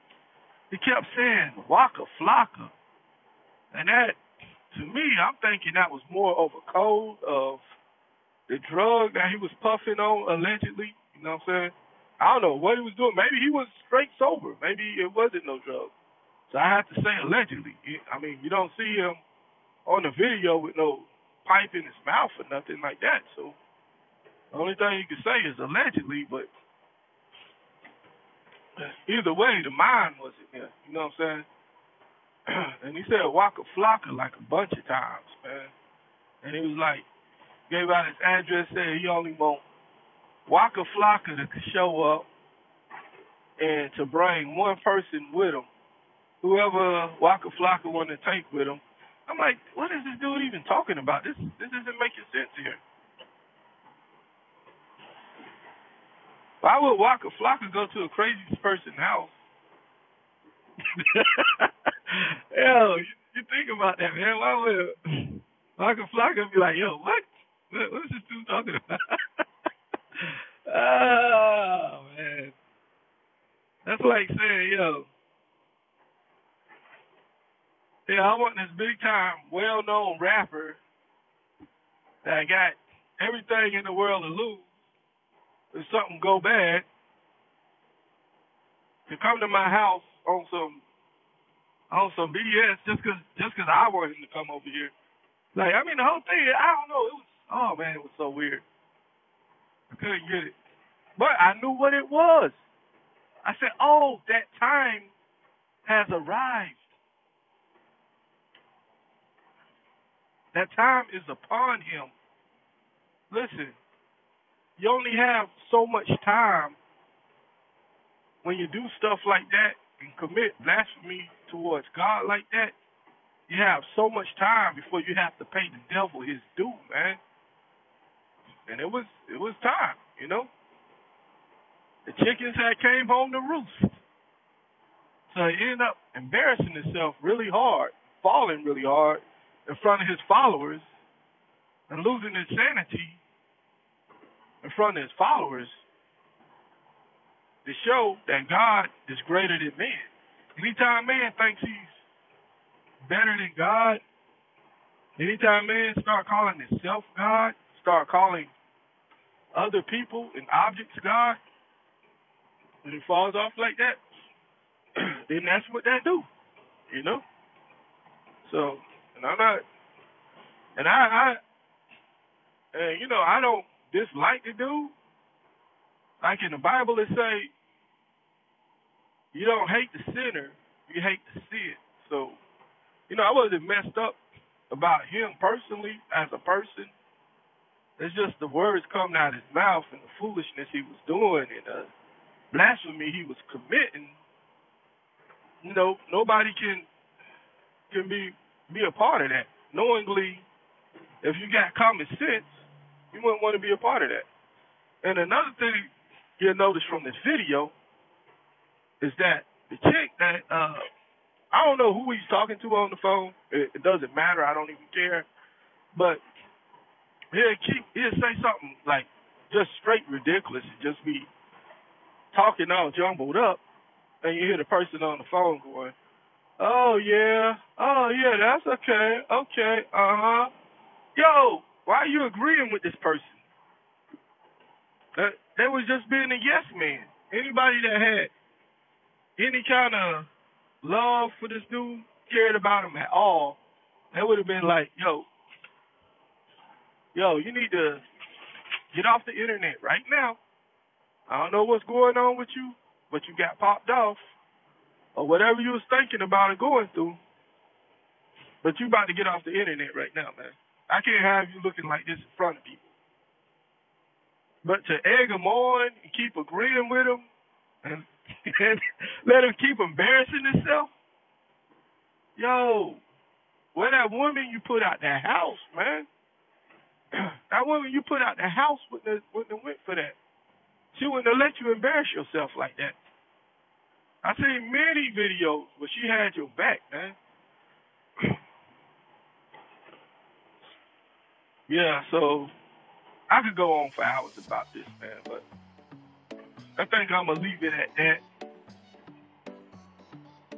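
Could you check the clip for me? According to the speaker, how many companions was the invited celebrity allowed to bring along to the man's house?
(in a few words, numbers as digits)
1.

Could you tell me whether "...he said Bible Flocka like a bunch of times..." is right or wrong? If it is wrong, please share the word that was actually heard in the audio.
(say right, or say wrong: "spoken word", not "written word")
wrong: "Waka", not "Bible".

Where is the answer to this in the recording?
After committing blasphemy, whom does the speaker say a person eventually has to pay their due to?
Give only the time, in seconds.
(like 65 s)
125 s.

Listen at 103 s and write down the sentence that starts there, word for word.
I said, oh, that time has arrived.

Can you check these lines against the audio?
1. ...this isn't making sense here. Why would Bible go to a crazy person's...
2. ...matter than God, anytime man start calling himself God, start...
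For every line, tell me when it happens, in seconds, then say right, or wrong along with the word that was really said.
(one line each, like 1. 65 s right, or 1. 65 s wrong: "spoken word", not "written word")
1. 51 s wrong: "Flocka", not "Bible"
2. 153 s wrong: "better", not "matter".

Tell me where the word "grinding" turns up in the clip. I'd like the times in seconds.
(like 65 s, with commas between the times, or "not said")
not said.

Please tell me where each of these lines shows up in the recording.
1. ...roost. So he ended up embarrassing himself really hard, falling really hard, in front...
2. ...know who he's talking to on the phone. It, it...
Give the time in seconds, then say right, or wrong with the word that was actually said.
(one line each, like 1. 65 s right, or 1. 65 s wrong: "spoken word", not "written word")
1. 133 s right
2. 211 s right.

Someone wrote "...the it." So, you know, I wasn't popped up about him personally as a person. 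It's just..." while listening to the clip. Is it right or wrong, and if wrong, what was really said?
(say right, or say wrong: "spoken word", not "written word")
wrong: "messed", not "popped".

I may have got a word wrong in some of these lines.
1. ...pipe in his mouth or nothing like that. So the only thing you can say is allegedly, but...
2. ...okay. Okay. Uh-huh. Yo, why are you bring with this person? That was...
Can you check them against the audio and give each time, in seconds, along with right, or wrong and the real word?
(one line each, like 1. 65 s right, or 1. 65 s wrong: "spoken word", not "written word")
1. 21 s right
2. 228 s wrong: "agreeing", not "bring".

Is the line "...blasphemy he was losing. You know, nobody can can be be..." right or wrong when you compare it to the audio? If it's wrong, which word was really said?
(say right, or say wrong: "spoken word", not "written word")
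wrong: "committing", not "losing".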